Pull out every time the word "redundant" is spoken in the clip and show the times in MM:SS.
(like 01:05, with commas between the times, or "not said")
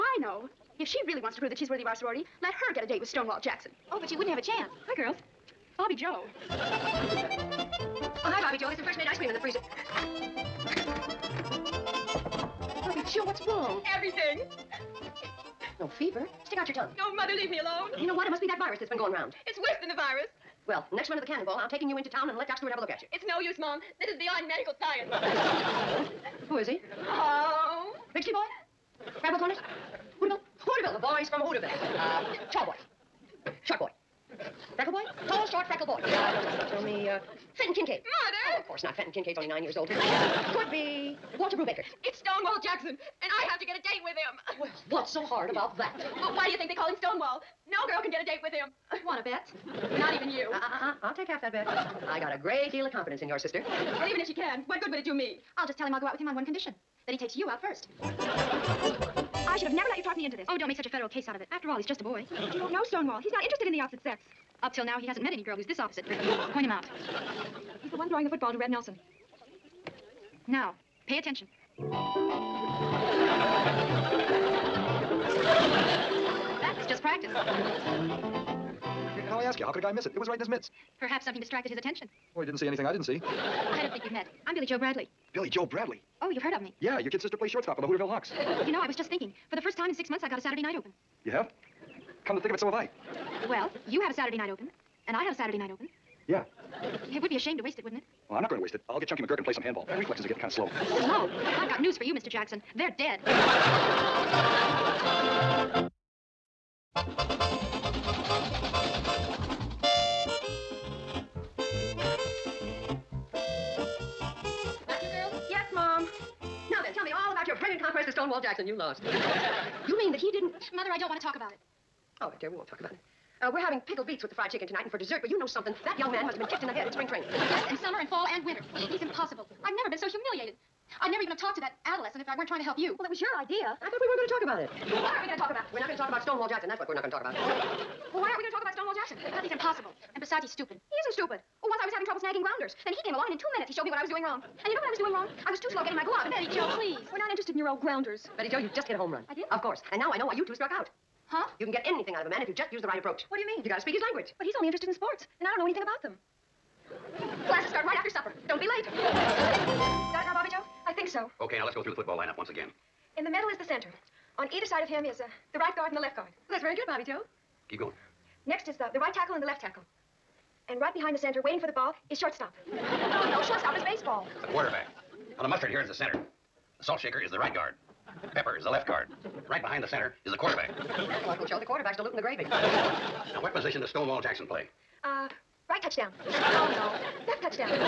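not said.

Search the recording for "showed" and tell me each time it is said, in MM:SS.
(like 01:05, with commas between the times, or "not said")
02:23.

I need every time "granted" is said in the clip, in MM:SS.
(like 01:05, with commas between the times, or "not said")
not said.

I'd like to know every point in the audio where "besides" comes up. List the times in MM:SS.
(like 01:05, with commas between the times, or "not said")
02:20.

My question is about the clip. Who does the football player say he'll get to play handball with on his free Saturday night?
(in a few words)
Chunky McGurk.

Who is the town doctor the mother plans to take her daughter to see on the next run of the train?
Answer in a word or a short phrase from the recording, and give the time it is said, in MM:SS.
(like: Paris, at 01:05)
Doc Stewart, at 00:22.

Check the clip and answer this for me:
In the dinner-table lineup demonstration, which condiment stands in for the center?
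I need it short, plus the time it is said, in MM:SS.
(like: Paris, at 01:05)
mustard, at 02:55.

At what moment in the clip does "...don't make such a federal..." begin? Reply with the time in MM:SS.
01:00.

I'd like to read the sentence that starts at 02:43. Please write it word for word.
In the middle is the center.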